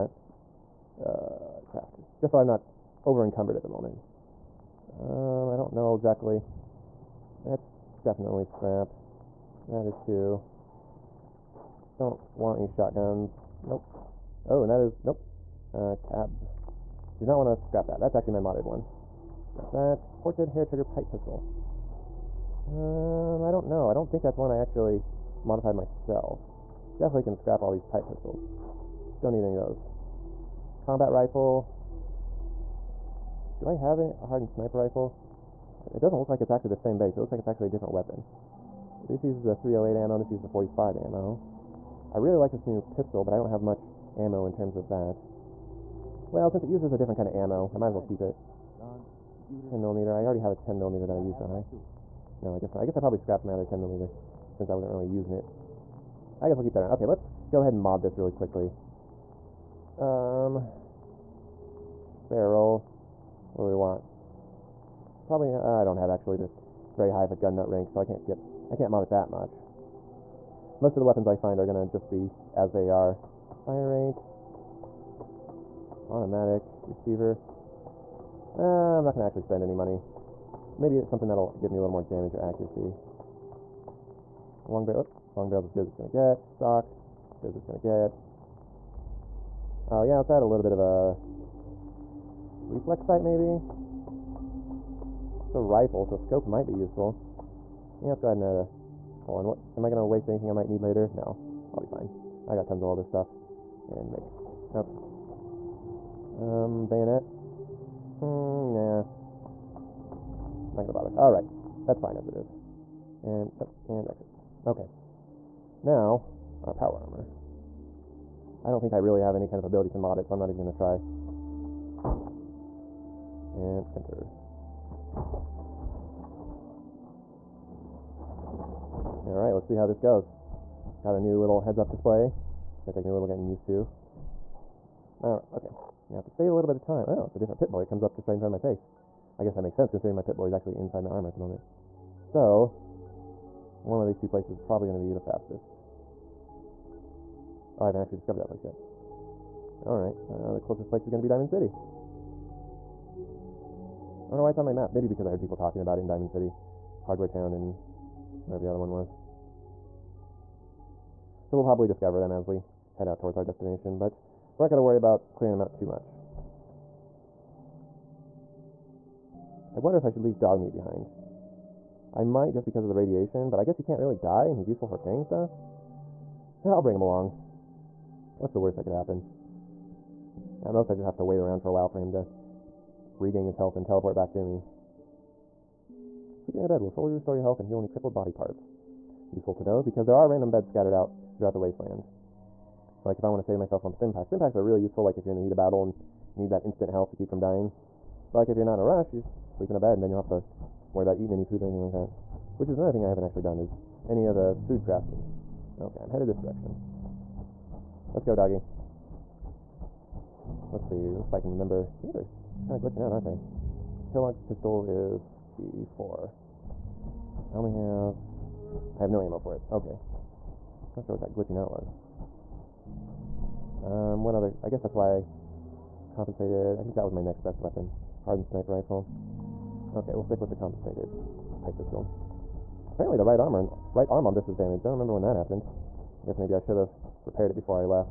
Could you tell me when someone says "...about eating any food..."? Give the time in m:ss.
3:21.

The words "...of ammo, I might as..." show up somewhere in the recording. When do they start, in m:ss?
0:47.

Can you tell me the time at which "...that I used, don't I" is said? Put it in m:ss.
0:51.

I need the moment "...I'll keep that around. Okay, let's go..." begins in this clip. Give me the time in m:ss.
0:56.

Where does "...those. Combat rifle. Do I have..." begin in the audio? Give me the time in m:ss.
0:29.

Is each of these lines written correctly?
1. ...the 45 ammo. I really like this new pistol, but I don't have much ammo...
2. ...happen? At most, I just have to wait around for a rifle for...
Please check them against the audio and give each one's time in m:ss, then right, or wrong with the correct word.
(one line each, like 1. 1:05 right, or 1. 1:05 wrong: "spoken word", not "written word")
1. 0:40 right
2. 2:58 wrong: "while", not "rifle".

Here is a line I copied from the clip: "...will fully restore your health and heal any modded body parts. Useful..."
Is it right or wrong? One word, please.
wrong.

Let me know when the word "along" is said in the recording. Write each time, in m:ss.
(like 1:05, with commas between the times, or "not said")
2:57.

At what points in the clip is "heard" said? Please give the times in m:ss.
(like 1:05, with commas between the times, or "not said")
2:35.